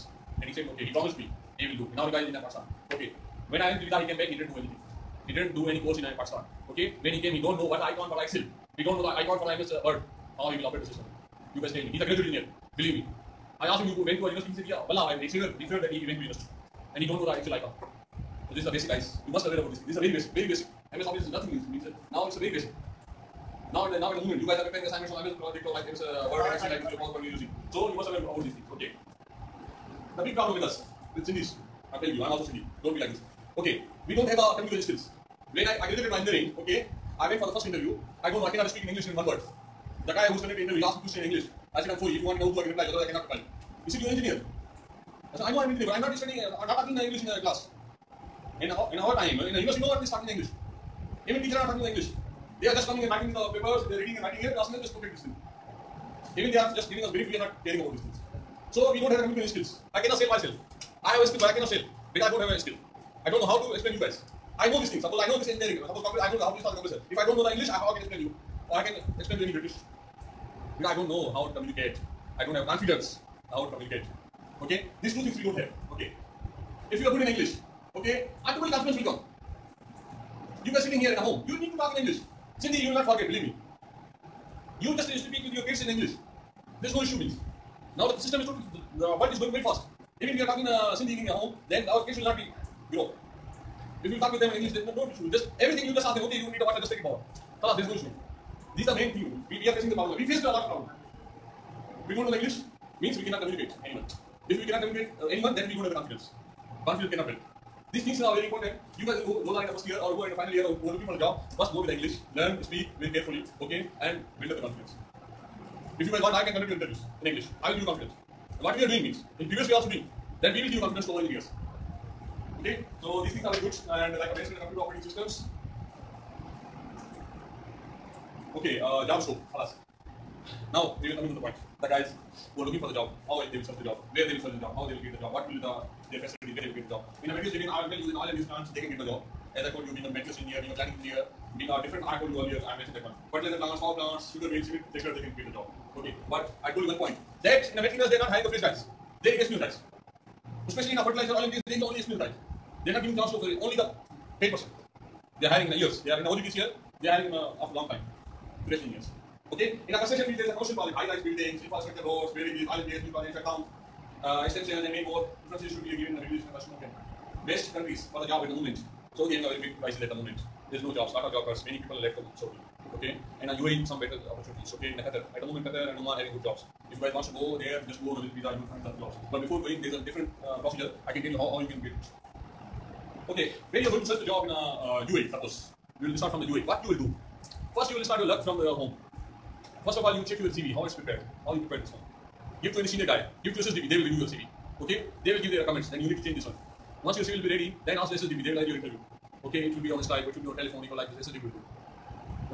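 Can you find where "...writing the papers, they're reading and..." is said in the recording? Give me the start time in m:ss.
0:53.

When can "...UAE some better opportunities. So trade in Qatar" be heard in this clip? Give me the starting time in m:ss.
2:53.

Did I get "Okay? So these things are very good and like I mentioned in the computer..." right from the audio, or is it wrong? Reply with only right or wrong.
right.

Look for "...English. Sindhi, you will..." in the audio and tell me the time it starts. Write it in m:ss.
1:22.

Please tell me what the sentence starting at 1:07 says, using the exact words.
If I don't know the English, I, how I can explain you?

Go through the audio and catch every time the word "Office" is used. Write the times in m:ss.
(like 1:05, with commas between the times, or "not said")
0:21.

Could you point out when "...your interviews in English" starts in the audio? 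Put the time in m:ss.
1:56.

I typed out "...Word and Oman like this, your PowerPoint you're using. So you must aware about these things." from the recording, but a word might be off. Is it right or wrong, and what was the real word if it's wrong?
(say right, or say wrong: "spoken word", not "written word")
wrong: "Excel", not "Oman".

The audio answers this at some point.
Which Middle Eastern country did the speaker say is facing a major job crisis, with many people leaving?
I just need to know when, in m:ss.
2:49.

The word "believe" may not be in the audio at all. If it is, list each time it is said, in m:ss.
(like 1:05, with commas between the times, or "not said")
0:12, 1:23.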